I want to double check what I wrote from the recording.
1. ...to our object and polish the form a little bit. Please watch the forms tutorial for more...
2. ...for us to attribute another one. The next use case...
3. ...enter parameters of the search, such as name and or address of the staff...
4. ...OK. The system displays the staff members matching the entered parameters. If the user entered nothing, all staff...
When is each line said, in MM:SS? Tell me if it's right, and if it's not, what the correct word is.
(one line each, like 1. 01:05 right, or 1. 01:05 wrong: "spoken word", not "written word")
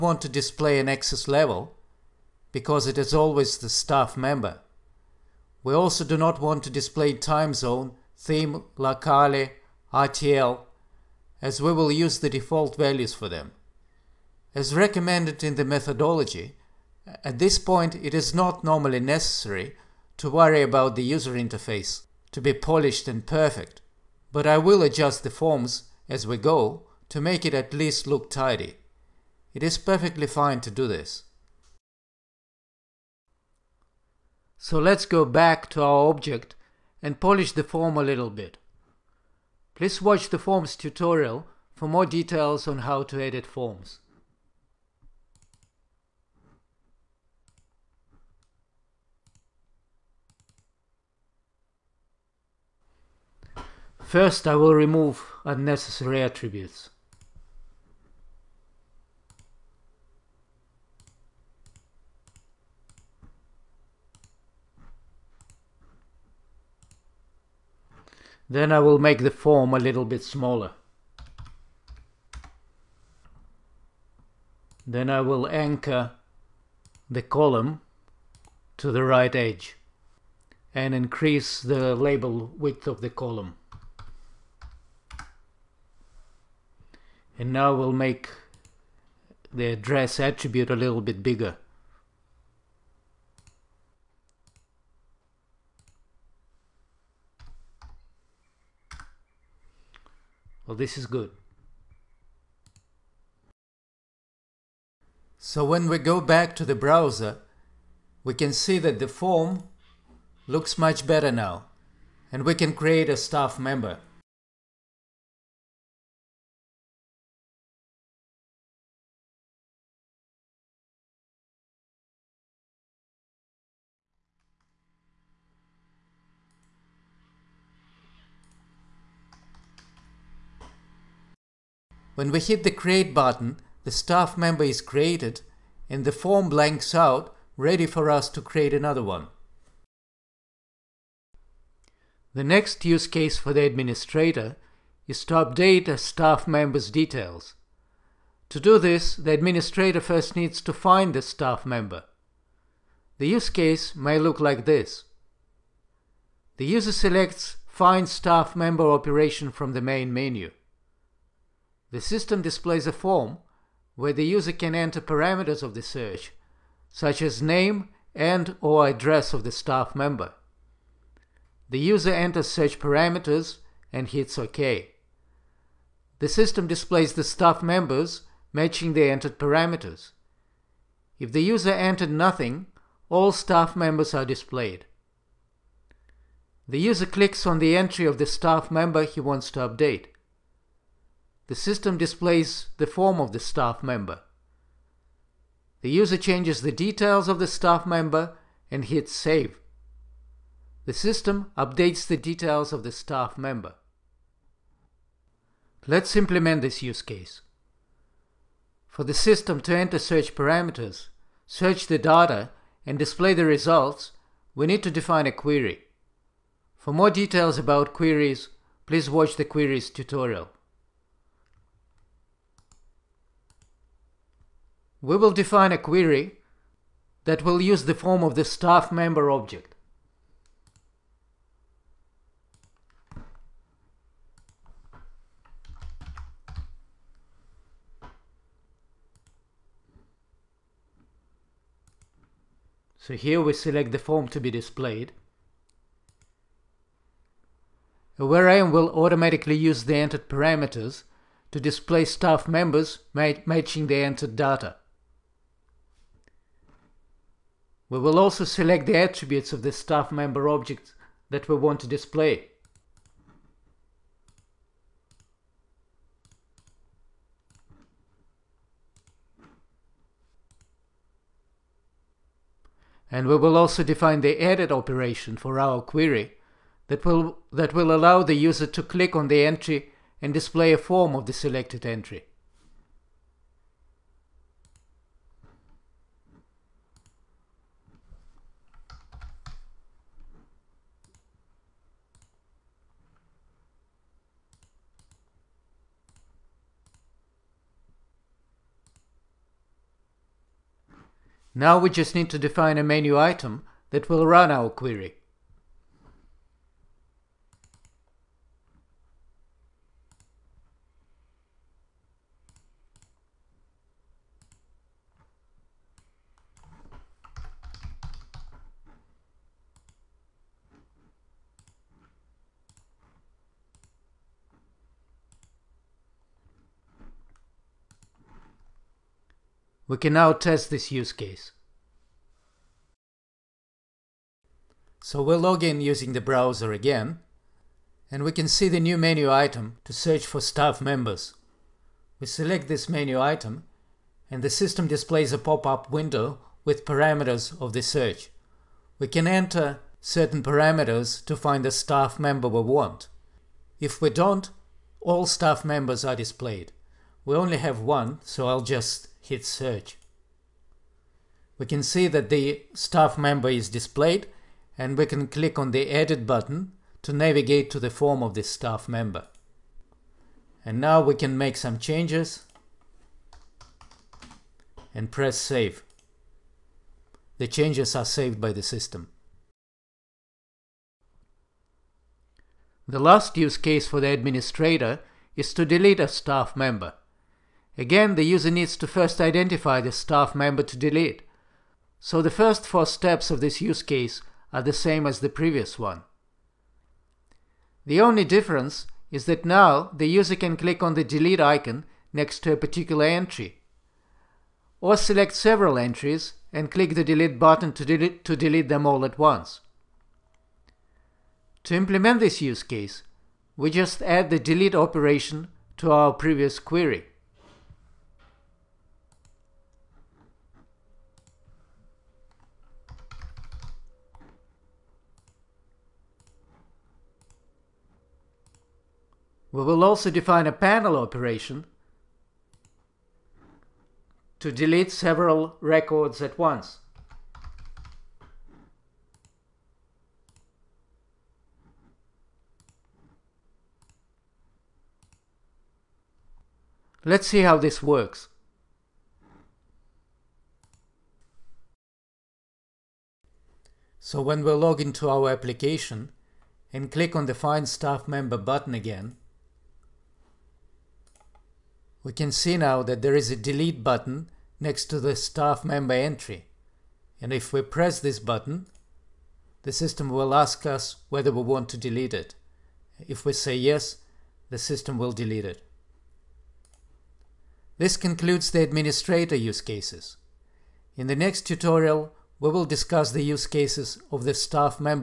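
1. 00:35 right
2. 02:17 wrong: "create", not "attribute"
3. 02:44 right
4. 02:54 right.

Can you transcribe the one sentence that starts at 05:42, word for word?
We select this menu item, and the system displays a pop-up window with parameters of the search.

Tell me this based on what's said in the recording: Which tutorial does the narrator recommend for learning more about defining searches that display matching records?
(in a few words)
queries tutorial.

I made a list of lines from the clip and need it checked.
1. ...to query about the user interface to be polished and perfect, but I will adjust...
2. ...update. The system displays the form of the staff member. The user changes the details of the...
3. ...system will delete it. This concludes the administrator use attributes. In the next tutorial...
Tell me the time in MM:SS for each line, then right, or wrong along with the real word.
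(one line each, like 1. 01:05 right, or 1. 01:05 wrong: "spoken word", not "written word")
1. 00:20 wrong: "worry", not "query"
2. 03:09 right
3. 07:54 wrong: "cases", not "attributes".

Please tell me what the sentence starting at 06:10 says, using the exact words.
And now we can make some changes and press save.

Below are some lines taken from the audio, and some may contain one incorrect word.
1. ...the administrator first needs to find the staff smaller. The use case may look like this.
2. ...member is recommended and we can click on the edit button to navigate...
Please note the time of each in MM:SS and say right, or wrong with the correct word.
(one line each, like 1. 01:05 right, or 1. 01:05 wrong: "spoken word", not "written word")
1. 02:29 wrong: "member", not "smaller"
2. 06:03 wrong: "displayed", not "recommended".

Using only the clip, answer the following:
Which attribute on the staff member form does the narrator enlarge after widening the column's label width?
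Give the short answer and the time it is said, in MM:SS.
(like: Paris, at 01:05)
address attribute, at 01:29.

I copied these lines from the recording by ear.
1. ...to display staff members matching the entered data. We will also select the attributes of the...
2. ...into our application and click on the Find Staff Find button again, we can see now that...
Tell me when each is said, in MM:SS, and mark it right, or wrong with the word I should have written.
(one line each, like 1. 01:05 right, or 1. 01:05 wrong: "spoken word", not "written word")
1. 04:11 right
2. 07:34 wrong: "Member", not "Find".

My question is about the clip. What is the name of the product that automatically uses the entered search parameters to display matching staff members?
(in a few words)
Aware IM.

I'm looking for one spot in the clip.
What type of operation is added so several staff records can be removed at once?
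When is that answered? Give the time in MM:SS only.
07:10.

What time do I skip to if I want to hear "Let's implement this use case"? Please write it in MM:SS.
03:25.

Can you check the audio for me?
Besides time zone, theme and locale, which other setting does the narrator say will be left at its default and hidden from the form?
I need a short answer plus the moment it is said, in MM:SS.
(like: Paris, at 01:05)
RTL, at 00:09.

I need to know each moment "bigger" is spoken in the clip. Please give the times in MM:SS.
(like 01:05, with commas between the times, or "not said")
01:31.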